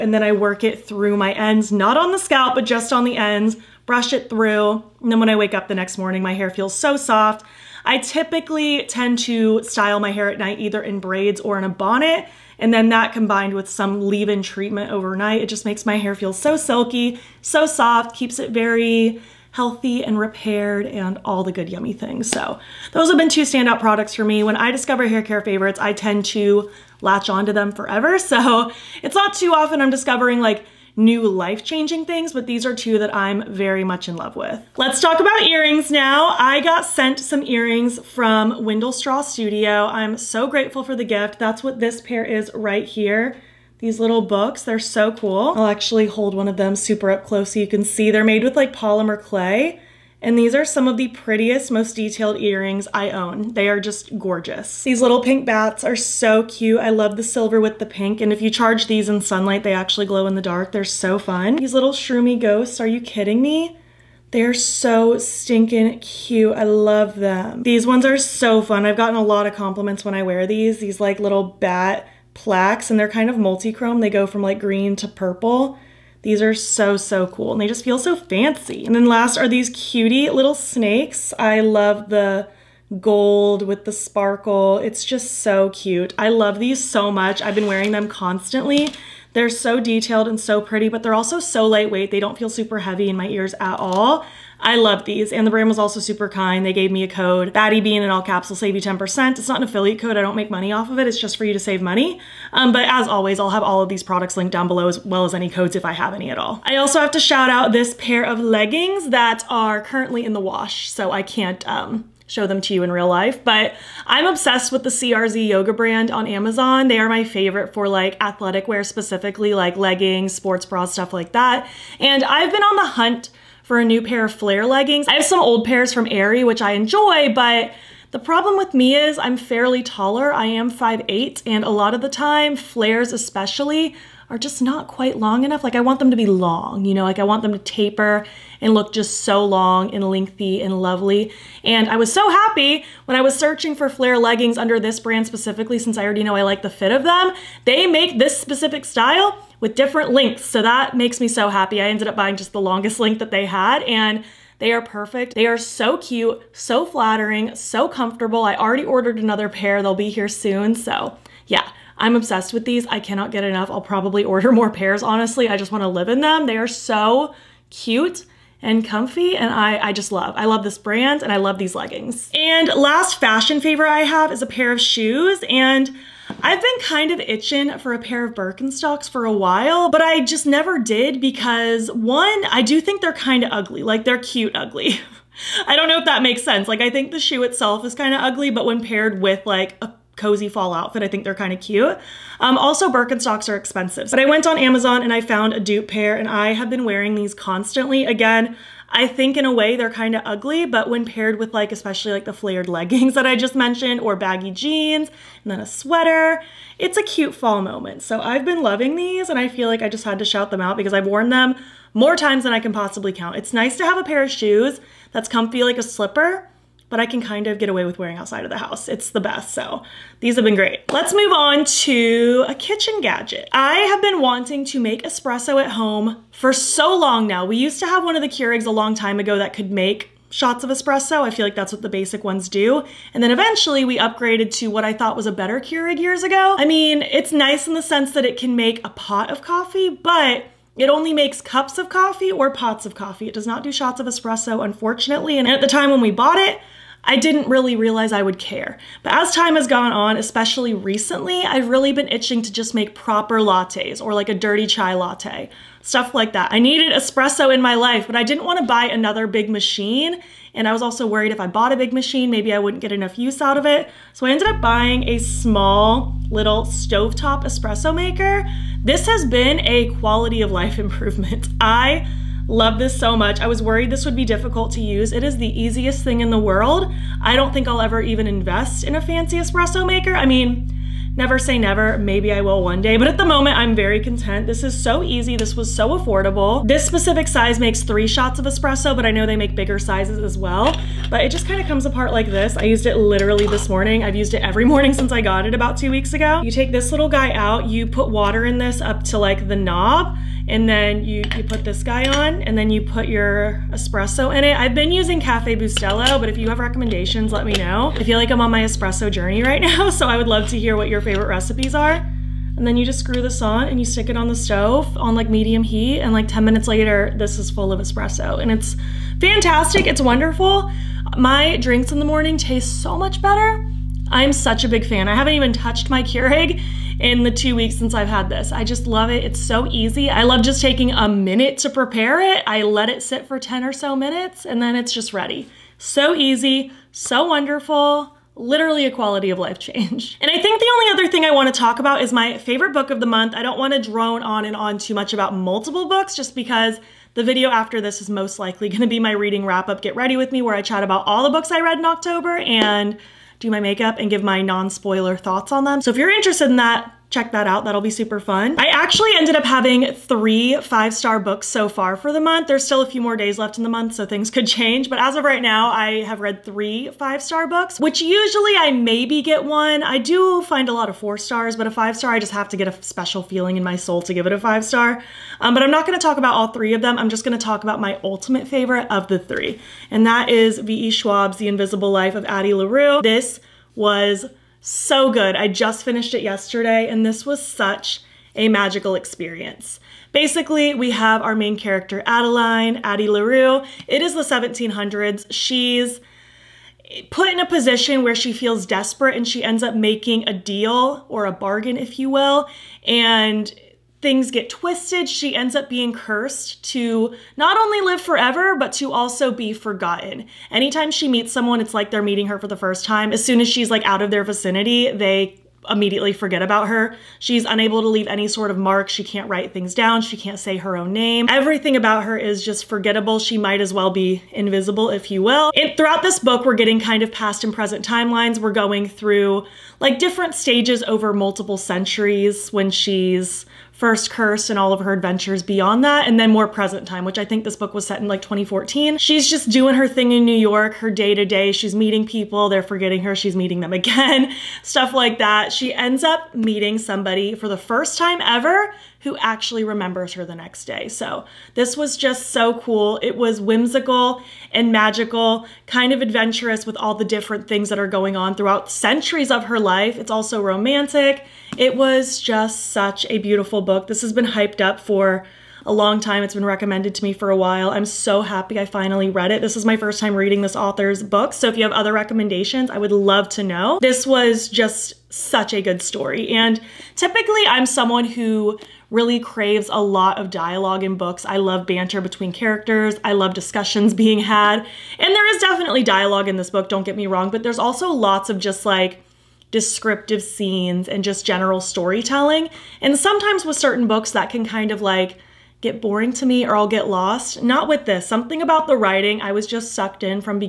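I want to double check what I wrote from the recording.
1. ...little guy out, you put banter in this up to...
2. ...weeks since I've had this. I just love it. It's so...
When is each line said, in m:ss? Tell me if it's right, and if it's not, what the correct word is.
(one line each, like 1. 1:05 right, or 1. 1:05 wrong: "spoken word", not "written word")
1. 4:56 wrong: "water", not "banter"
2. 5:27 right.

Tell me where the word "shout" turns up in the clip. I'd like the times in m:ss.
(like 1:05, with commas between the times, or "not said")
1:47, 3:30.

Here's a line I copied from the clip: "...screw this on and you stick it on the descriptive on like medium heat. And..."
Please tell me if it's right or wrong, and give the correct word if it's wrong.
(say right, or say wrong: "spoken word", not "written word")
wrong: "stove", not "descriptive".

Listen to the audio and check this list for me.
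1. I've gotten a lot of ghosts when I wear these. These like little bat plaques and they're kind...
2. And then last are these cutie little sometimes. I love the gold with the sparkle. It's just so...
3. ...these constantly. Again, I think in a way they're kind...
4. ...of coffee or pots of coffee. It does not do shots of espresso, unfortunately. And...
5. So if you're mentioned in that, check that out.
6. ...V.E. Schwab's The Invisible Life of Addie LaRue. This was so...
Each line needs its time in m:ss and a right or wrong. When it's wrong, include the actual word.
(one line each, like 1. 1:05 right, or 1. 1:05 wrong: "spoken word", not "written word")
1. 1:08 wrong: "compliments", not "ghosts"
2. 1:18 wrong: "snakes", not "sometimes"
3. 3:17 right
4. 4:01 right
5. 5:55 wrong: "interested", not "mentioned"
6. 6:20 right.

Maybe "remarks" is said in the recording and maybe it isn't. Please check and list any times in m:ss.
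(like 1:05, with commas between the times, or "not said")
not said.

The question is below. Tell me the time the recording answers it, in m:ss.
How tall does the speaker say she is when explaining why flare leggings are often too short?
2:10.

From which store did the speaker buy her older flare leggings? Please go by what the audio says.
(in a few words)
Aerie.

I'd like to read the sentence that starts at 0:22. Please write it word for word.
So those have been two standout products for me.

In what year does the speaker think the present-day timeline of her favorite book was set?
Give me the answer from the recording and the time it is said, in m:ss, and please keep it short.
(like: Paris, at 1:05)
2014, at 7:18.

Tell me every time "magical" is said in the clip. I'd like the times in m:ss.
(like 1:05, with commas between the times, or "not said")
6:28, 7:34.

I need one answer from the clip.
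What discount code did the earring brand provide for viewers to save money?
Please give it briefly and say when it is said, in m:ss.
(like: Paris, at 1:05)
Batty Bean, at 1:37.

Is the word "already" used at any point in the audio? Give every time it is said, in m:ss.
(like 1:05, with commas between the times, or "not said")
2:26, 2:38.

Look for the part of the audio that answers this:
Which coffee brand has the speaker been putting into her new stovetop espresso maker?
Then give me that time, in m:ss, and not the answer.
5:05.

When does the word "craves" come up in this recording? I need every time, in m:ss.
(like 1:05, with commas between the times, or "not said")
7:59.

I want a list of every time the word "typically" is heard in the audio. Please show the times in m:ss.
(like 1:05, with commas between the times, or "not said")
0:07, 7:56.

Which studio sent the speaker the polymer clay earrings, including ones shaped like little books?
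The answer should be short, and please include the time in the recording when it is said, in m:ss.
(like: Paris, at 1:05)
Windlestraw Studio, at 0:38.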